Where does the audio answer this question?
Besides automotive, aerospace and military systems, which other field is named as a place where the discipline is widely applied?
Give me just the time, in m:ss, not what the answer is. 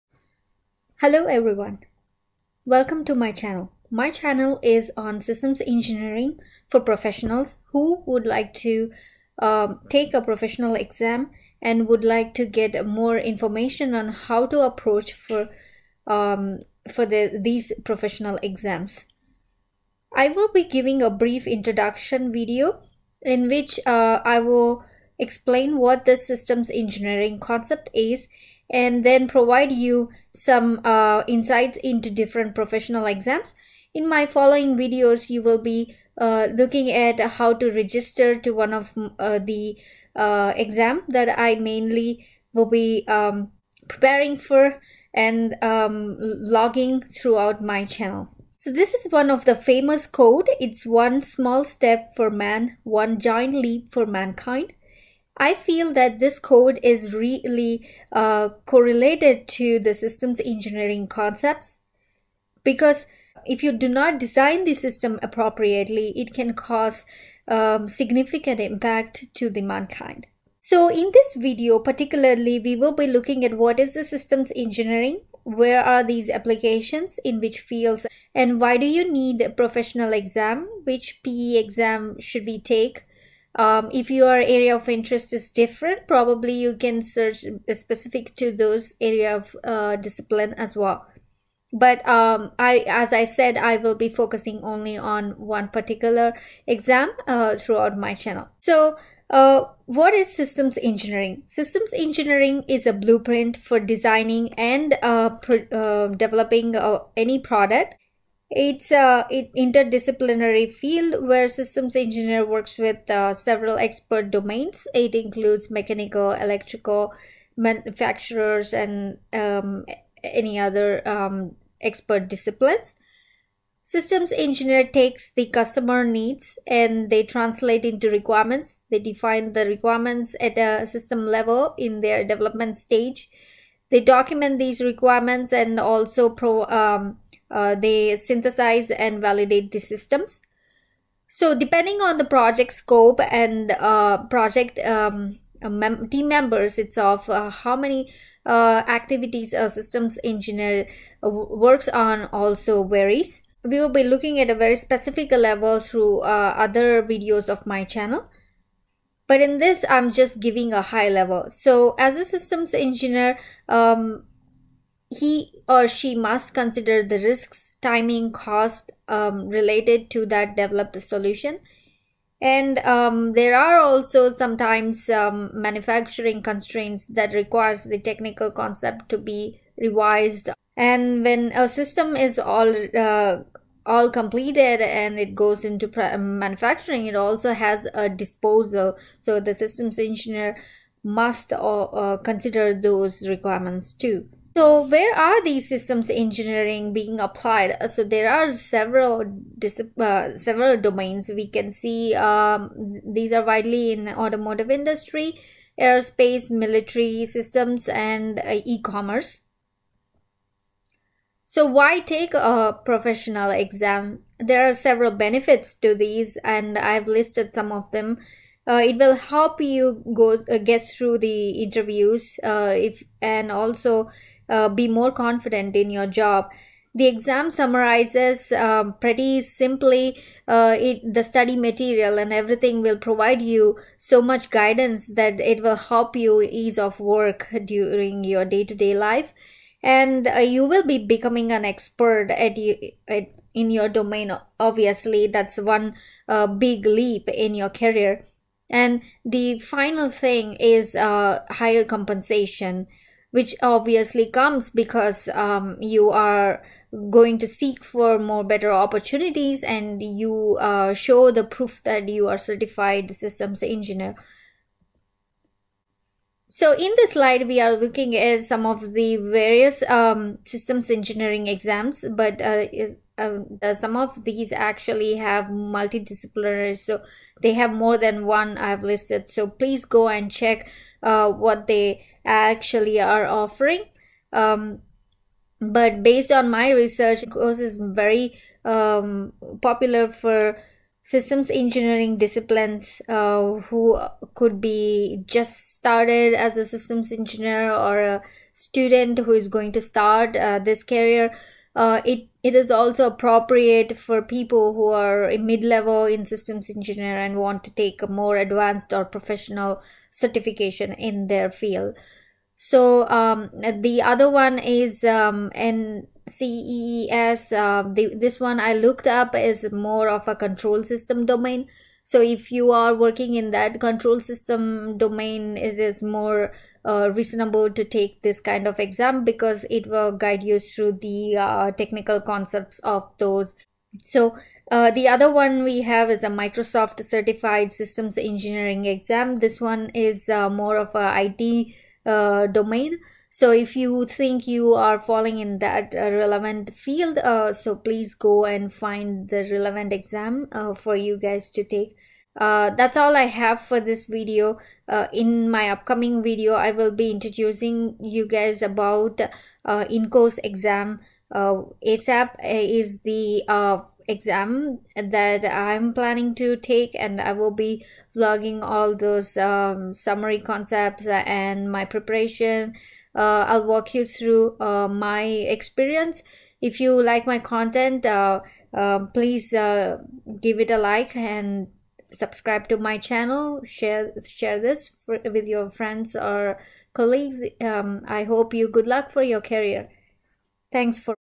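3:28.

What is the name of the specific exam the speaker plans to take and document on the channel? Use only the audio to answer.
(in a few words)
ASEP.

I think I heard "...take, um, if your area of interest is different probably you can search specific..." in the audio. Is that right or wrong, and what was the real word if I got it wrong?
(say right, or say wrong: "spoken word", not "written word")
right.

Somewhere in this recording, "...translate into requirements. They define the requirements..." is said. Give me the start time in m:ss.
2:07.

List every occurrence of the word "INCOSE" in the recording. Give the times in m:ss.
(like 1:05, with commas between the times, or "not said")
4:47, 5:59.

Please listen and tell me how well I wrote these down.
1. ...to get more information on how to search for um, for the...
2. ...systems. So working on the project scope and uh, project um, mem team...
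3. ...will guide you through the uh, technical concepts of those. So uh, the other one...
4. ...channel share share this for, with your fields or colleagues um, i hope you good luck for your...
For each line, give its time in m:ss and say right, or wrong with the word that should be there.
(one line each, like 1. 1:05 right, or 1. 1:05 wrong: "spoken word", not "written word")
1. 0:12 wrong: "approach", not "search"
2. 2:19 wrong: "depending", not "working"
3. 5:29 right
4. 6:22 wrong: "friends", not "fields".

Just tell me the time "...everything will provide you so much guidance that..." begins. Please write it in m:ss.
3:52.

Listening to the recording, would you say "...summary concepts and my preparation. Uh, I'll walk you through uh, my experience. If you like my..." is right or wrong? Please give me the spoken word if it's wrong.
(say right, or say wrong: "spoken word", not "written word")
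right.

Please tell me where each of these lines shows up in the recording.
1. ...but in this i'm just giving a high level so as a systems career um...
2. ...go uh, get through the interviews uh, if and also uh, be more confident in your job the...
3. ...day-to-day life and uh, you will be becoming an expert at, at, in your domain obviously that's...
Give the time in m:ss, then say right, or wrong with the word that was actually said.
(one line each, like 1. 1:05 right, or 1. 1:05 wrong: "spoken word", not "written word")
1. 2:39 wrong: "engineer", not "career"
2. 3:40 right
3. 3:58 right.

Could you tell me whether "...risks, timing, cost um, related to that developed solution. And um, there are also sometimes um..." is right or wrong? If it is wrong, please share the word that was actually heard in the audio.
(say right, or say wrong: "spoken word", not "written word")
right.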